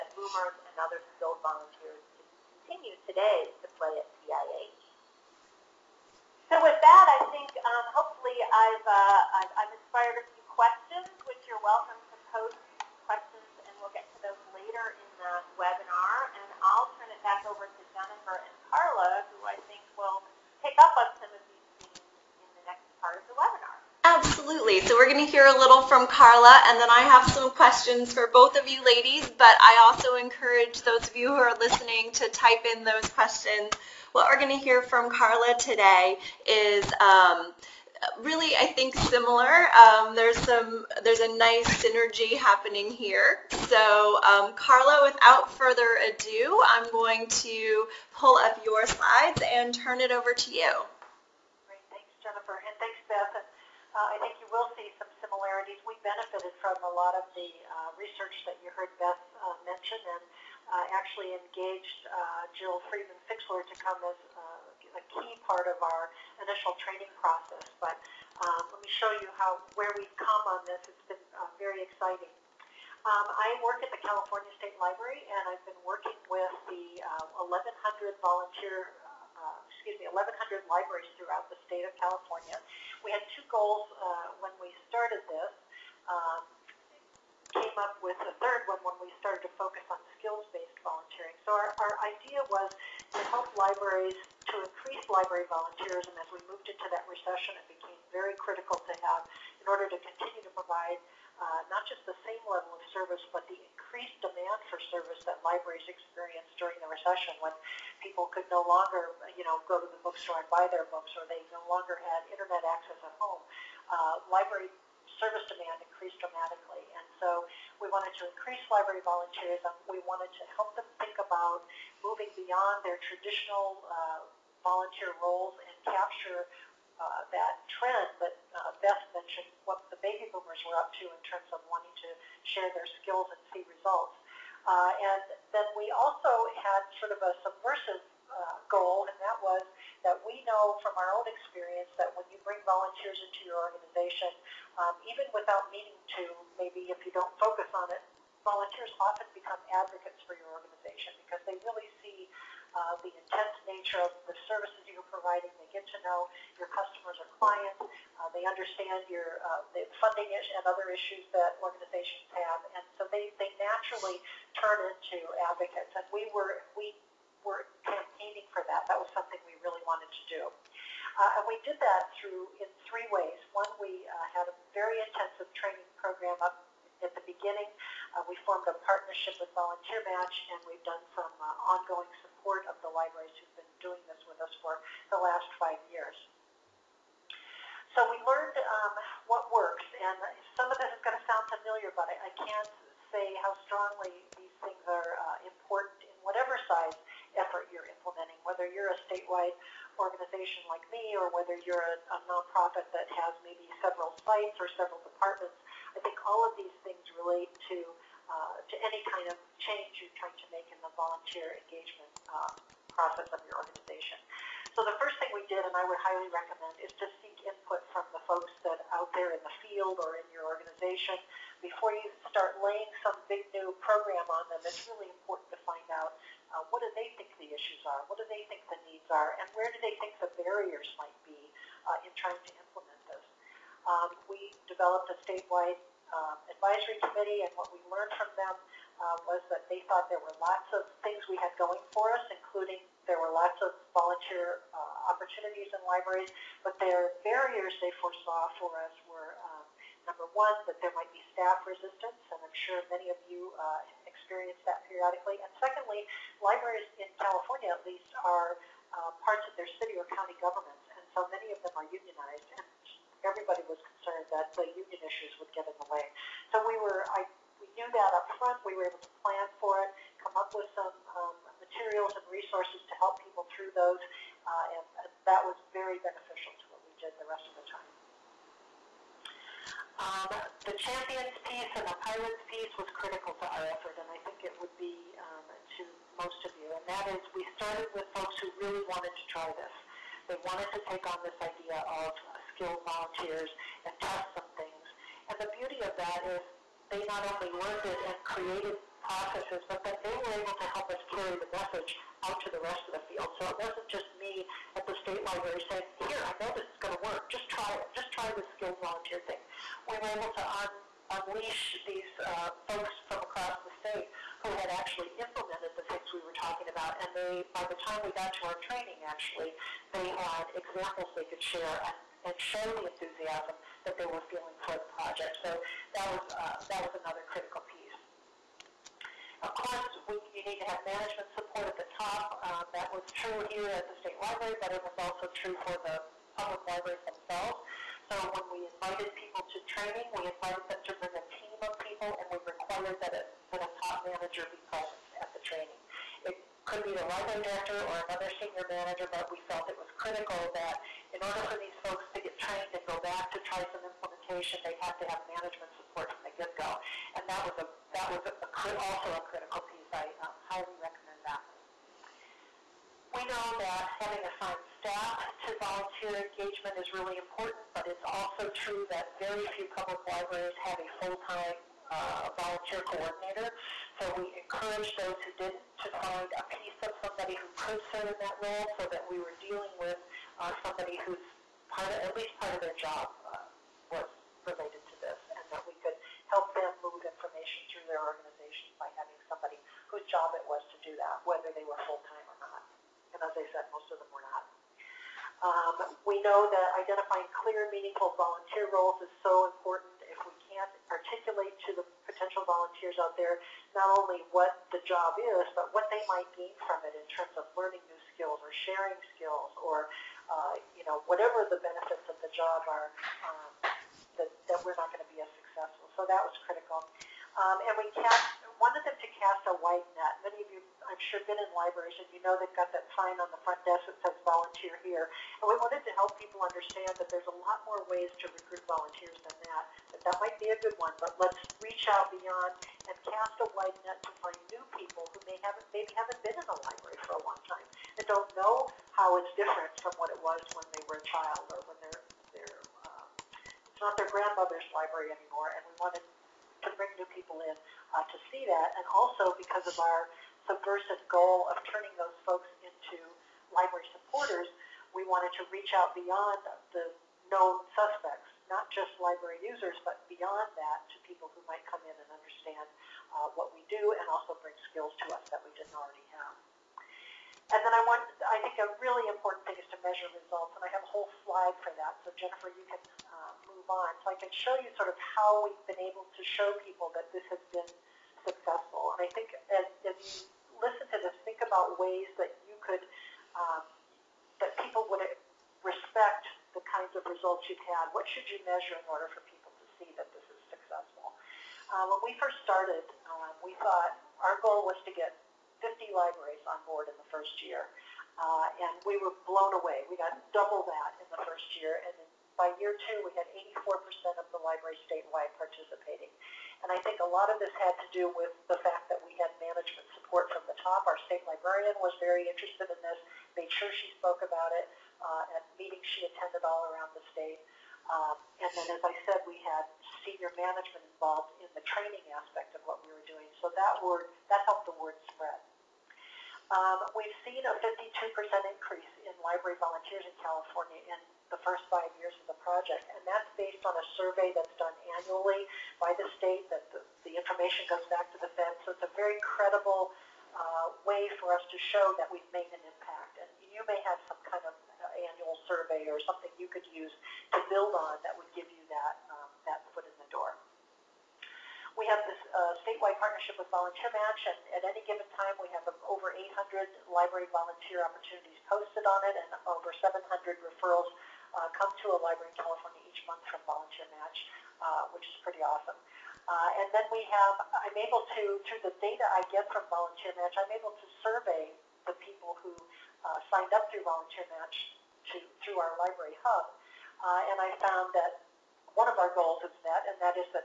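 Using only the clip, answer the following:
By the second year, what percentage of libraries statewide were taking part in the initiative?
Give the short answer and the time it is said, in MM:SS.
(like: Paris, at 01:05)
84%, at 08:23.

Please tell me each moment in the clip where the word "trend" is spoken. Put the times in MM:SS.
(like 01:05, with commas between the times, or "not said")
02:07.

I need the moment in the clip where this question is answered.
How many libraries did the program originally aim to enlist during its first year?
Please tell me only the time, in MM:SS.
08:15.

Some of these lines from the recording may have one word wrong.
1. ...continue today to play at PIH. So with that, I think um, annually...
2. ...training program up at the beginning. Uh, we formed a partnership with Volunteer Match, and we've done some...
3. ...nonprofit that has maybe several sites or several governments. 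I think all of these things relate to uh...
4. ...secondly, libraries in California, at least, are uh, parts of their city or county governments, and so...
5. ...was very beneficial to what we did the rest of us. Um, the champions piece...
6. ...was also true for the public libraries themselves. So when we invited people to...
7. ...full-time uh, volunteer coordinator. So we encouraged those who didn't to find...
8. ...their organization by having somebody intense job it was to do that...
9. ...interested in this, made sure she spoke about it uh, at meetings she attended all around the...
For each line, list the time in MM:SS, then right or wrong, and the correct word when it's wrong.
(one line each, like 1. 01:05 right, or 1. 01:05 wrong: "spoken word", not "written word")
1. 00:02 wrong: "hopefully", not "annually"
2. 02:55 right
3. 03:22 wrong: "departments", not "governments"
4. 04:15 right
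5. 04:35 right
6. 05:34 right
7. 06:10 right
8. 06:27 wrong: "whose", not "intense"
9. 08:32 right.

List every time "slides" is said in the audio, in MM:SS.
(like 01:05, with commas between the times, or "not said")
00:48, 07:51.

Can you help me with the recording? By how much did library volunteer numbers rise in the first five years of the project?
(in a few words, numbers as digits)
52%.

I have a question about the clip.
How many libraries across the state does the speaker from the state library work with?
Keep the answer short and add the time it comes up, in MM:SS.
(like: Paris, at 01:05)
1,100, at 01:20.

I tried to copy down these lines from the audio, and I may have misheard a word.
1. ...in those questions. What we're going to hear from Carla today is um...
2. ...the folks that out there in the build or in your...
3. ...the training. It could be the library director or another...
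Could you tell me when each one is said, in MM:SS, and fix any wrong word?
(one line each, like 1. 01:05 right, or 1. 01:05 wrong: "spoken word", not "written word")
1. 00:32 right
2. 03:38 wrong: "field", not "build"
3. 05:45 right.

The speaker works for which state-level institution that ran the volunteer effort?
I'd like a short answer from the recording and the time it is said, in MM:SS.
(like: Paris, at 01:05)
California State Library, at 01:14.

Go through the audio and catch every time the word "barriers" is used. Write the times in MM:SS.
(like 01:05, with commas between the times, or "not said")
03:50, 04:07.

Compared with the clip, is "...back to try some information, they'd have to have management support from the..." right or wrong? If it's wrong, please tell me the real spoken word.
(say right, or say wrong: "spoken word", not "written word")
wrong: "implementation", not "information".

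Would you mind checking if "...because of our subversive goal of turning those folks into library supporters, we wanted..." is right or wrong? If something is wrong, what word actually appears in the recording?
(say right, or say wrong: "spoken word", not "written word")
right.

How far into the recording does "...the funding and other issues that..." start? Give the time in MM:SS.
02:39.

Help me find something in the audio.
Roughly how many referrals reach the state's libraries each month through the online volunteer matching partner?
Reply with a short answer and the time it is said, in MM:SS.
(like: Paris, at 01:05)
over 700, at 09:19.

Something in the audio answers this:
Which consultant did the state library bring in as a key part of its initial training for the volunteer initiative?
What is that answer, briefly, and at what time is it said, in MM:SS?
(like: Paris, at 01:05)
Jill Friedman Fixler, at 01:02.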